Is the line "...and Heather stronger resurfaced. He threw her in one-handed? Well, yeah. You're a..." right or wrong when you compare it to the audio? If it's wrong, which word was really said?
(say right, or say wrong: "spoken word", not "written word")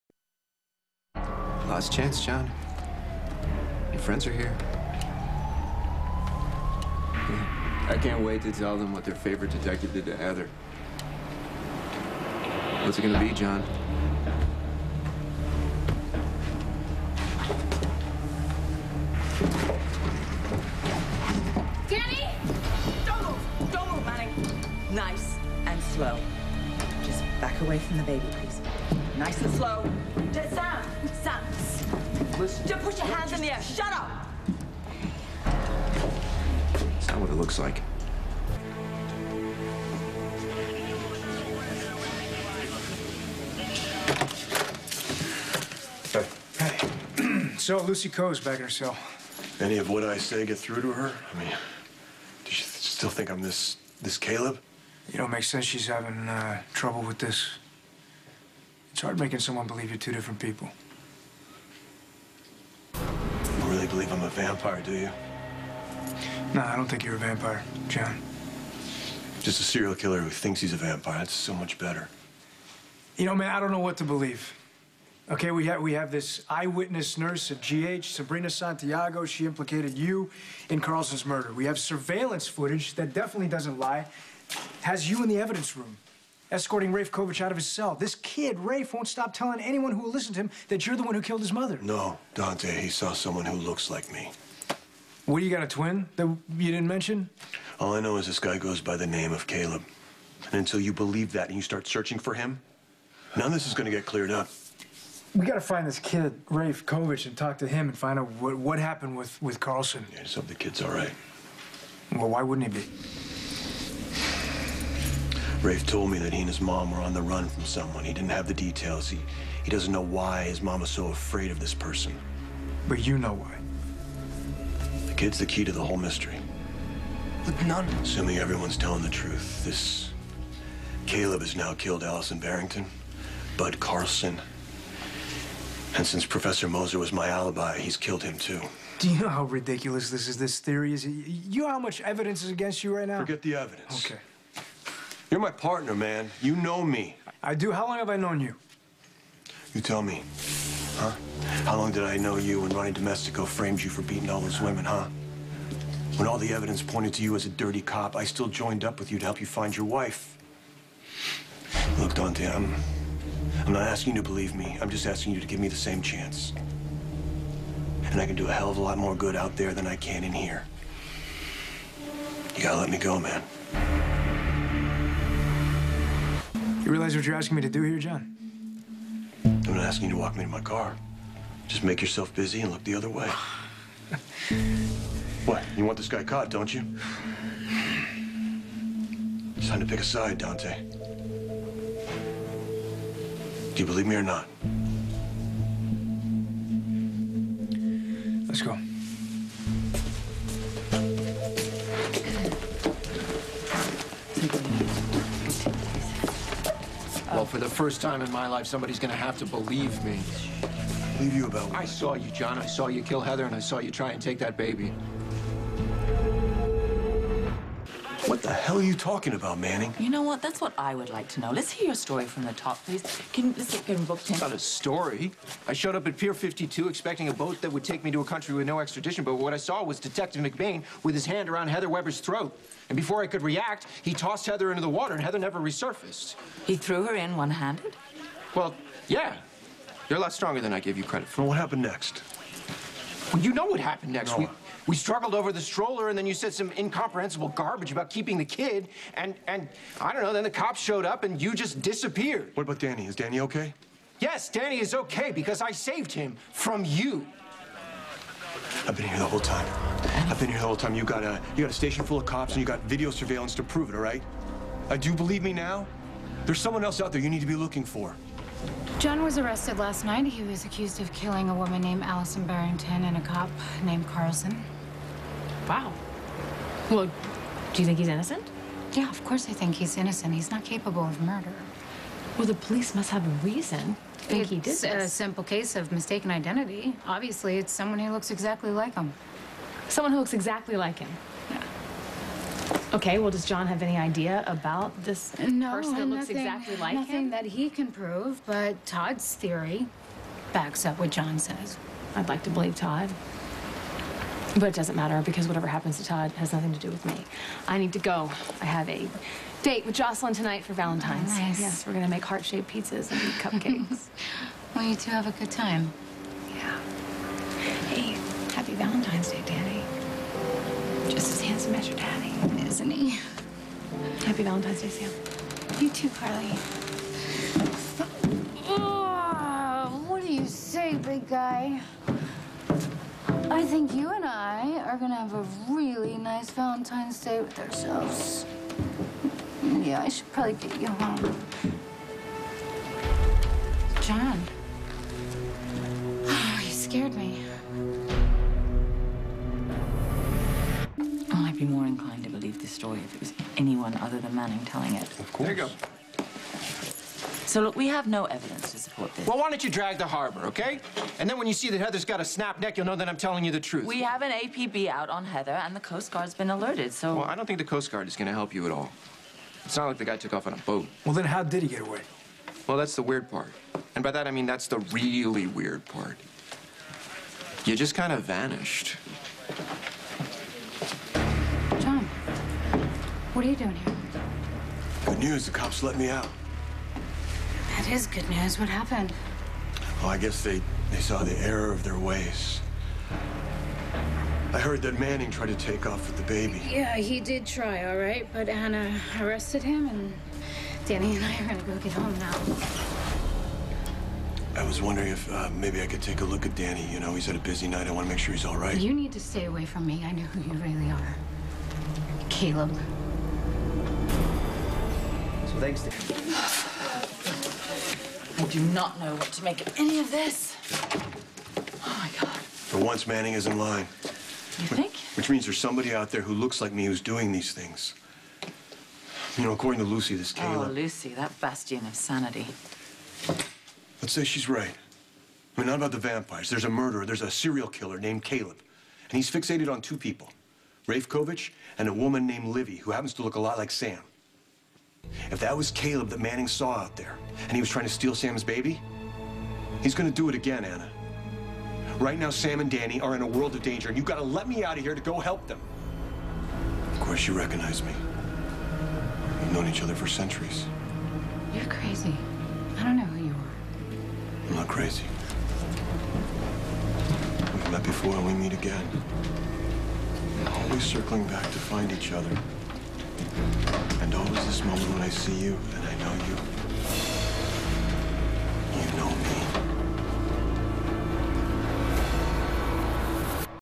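wrong: "never", not "stronger".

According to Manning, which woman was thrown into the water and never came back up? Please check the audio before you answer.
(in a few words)
Heather Weber.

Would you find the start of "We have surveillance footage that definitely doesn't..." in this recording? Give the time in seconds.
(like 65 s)
81 s.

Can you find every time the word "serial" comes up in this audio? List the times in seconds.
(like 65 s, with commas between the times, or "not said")
69 s, 437 s.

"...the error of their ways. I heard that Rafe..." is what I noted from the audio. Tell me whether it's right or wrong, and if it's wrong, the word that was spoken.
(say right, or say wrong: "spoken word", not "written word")
wrong: "Manning", not "Rafe".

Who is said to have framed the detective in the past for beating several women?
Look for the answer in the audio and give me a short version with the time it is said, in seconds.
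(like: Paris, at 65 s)
Ronnie Domestico, at 152 s.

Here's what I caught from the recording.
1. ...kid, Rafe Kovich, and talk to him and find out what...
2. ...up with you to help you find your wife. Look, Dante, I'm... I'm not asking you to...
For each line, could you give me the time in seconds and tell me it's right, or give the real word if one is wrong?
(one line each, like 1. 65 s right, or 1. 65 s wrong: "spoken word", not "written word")
1. 105 s right
2. 158 s right.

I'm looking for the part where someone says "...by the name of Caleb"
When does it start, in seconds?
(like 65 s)
98 s.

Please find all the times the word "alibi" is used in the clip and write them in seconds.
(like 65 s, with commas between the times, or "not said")
137 s.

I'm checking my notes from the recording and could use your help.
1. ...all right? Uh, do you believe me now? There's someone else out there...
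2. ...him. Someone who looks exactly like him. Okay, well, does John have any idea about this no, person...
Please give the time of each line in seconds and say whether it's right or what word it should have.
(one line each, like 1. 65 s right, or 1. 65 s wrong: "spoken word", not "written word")
1. 263 s right
2. 288 s right.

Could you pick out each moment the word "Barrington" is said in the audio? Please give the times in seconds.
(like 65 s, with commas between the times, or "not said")
132 s, 272 s.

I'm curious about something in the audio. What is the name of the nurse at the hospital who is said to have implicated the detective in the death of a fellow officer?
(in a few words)
Sabrina Santiago.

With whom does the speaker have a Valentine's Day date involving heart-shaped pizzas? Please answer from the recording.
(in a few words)
Jocelyn.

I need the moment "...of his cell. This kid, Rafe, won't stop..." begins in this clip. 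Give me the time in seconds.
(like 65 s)
87 s.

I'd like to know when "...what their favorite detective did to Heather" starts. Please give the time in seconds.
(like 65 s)
8 s.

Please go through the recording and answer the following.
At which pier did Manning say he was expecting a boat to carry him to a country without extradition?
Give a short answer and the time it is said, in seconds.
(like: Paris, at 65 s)
Pier 52, at 226 s.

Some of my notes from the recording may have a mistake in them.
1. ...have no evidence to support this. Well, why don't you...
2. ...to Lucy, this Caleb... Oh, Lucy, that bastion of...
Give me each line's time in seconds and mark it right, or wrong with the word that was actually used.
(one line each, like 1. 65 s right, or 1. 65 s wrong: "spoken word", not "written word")
1. 357 s right
2. 429 s right.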